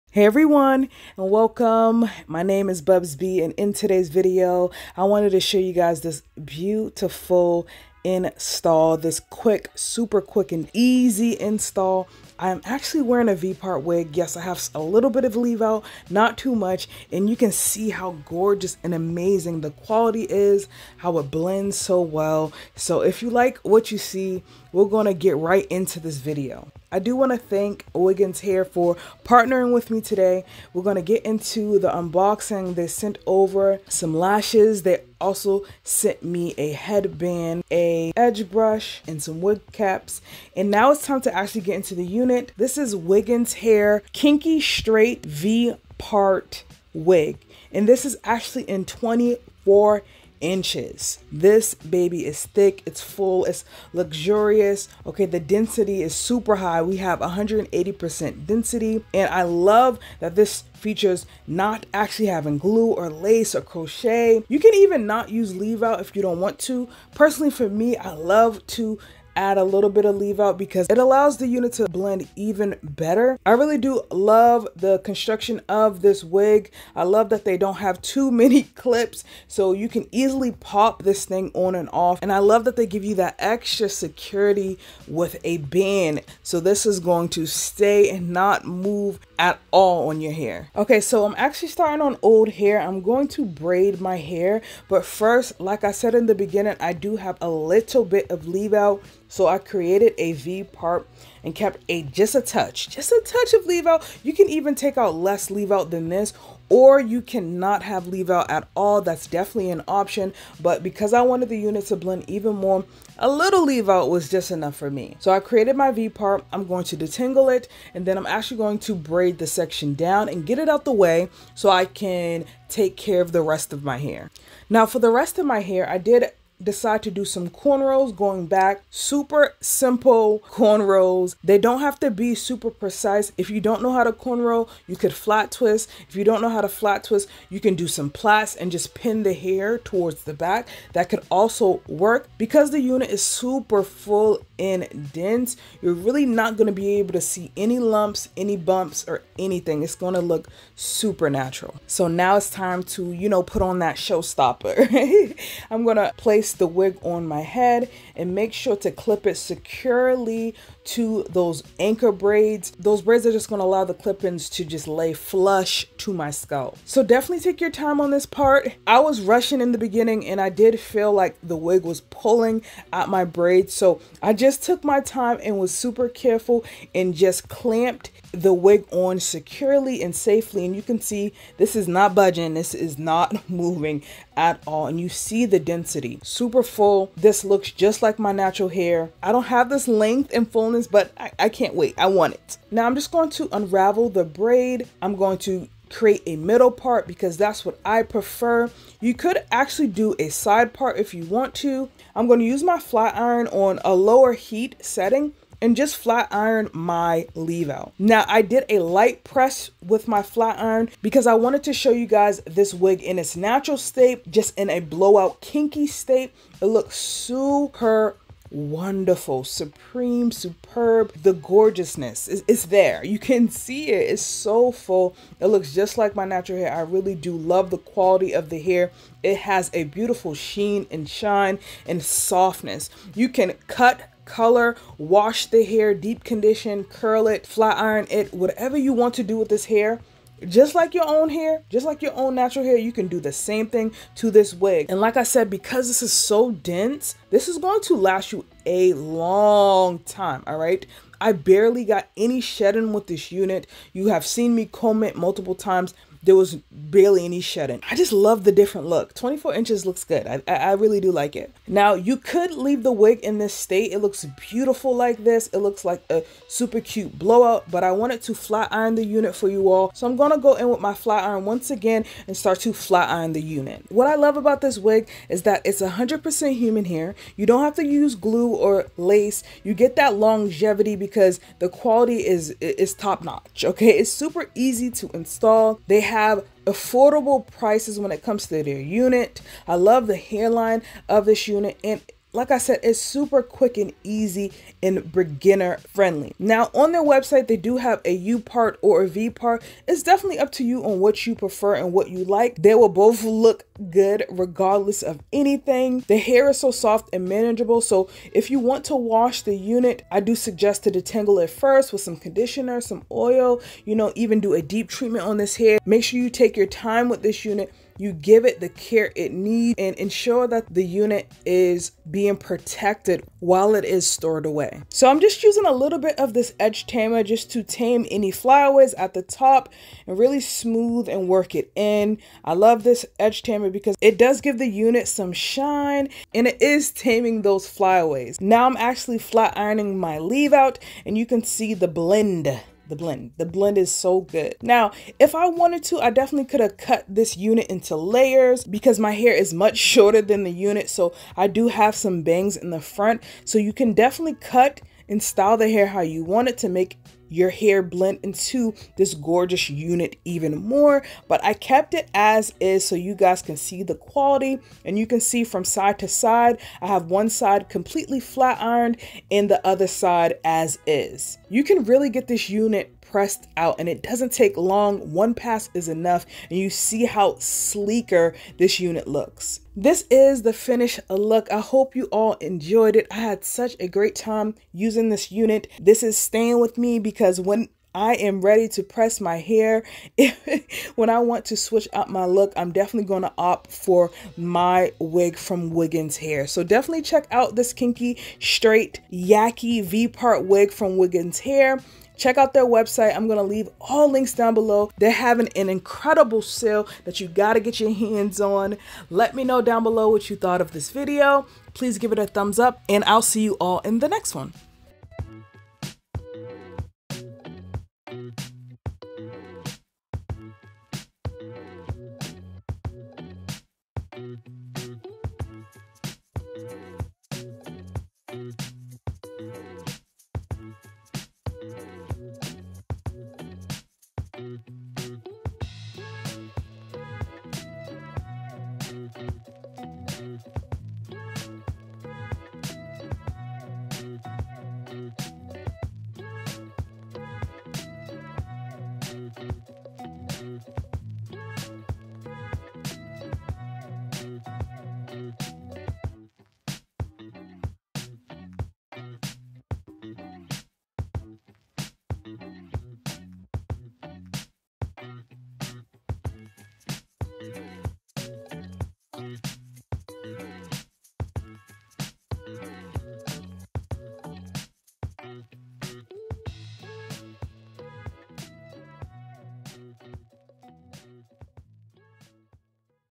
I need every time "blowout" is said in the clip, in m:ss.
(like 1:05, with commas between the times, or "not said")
3:34, 4:27.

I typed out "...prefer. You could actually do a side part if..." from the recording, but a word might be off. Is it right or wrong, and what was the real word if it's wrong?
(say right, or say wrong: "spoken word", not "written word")
right.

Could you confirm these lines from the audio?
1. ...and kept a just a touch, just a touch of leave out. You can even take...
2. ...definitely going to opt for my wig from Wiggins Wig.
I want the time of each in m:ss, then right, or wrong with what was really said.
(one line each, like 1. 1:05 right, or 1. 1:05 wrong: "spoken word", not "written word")
1. 1:41 right
2. 6:32 wrong: "Hair", not "Wig".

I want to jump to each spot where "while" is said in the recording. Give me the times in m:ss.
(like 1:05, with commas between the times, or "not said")
5:23.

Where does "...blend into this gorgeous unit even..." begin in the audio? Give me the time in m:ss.
5:57.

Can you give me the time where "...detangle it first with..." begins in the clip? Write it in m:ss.
5:10.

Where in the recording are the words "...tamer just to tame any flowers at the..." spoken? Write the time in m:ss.
5:26.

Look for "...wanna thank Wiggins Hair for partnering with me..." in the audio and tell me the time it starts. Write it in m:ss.
0:27.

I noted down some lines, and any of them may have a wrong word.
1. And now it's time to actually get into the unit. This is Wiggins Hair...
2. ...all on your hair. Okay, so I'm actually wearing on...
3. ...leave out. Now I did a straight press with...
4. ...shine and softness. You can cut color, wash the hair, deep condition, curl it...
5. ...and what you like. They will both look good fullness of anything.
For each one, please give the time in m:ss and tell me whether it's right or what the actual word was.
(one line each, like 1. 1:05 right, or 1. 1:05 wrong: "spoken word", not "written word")
1. 0:40 right
2. 1:29 wrong: "starting", not "wearing"
3. 3:27 wrong: "light", not "straight"
4. 3:51 right
5. 5:01 wrong: "regardless", not "fullness".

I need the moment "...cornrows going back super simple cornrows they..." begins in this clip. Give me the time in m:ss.
2:07.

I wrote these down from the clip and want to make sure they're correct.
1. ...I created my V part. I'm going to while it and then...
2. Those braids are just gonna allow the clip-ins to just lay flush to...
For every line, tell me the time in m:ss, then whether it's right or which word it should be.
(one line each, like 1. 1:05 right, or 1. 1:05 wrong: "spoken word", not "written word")
1. 1:55 wrong: "detangle", not "while"
2. 2:42 right.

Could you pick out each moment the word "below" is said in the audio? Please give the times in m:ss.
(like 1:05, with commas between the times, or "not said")
6:44, 6:49.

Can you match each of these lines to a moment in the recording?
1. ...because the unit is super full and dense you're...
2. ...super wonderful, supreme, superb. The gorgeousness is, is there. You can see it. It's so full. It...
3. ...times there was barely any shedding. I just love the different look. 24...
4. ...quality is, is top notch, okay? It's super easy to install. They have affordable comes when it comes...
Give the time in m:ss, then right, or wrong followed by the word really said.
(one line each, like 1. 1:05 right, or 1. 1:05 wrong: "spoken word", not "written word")
1. 2:22 right
2. 3:36 right
3. 4:15 right
4. 4:41 wrong: "prices", not "comes".